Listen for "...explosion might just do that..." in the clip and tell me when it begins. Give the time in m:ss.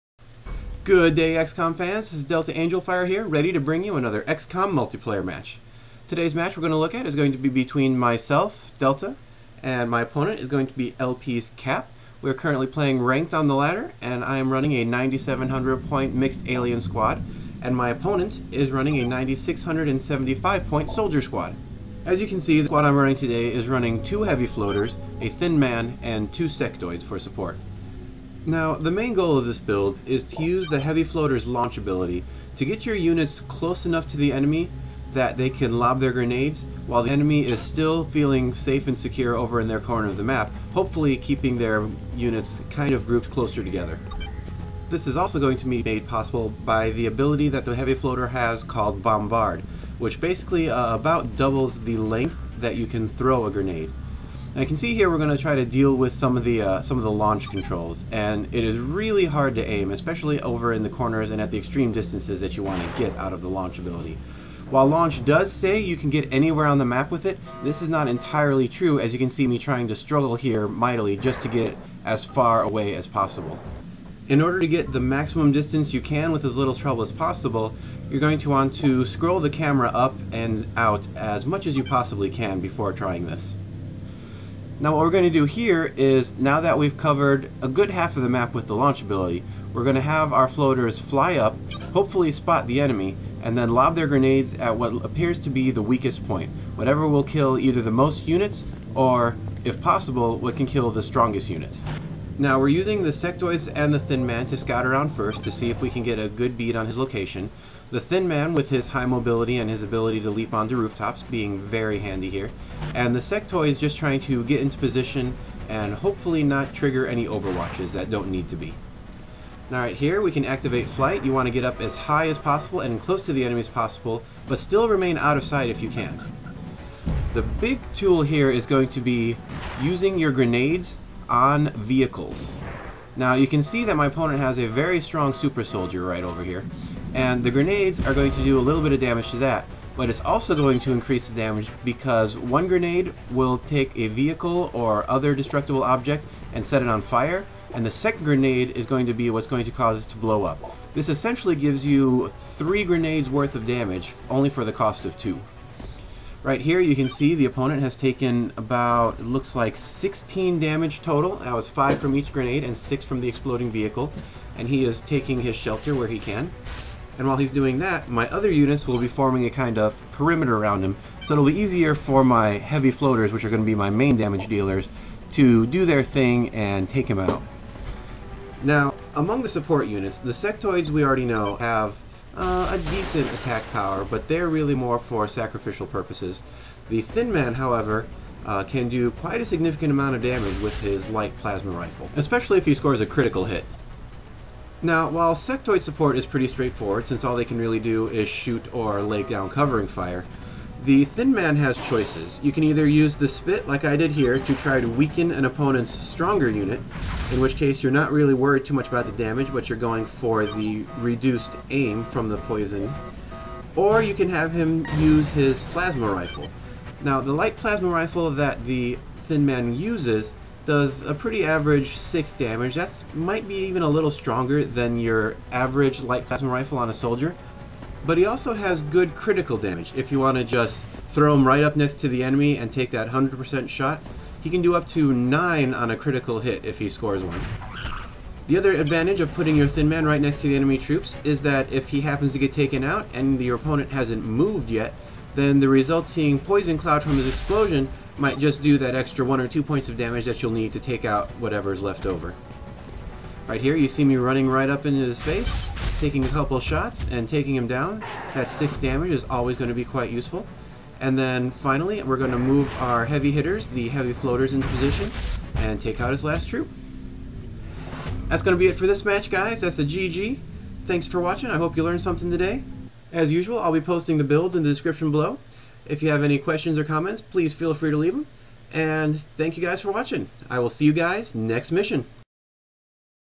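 4:07.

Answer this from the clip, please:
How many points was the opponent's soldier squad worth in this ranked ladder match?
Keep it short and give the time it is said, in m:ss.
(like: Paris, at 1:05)
9,675, at 0:19.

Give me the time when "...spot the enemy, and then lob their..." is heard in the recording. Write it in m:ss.
1:32.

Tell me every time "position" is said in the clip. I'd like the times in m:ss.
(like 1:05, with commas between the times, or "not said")
1:54, 4:24.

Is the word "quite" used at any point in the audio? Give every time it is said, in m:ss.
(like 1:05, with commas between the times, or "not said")
3:09, 4:19.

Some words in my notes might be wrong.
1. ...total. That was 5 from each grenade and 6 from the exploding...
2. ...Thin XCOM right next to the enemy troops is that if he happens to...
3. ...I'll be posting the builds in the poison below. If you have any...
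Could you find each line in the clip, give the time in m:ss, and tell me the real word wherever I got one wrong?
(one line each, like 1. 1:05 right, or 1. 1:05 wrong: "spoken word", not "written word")
1. 2:41 right
2. 3:59 wrong: "Man", not "XCOM"
3. 4:33 wrong: "description", not "poison".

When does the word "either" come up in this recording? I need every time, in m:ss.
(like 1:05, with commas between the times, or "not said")
1:37, 3:22.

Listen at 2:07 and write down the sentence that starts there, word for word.
The big tool here is going to be using your grenades on vehicles.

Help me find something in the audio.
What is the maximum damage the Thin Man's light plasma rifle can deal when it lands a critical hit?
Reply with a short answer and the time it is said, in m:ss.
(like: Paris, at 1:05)
9, at 3:55.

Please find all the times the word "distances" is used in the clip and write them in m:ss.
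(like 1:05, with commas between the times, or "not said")
1:01, 1:15.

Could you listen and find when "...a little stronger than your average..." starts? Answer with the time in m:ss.
3:43.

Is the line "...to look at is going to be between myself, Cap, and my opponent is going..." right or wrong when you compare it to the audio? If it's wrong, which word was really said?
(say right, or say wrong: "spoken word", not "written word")
wrong: "Delta", not "Cap".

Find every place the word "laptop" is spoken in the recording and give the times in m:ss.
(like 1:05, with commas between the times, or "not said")
not said.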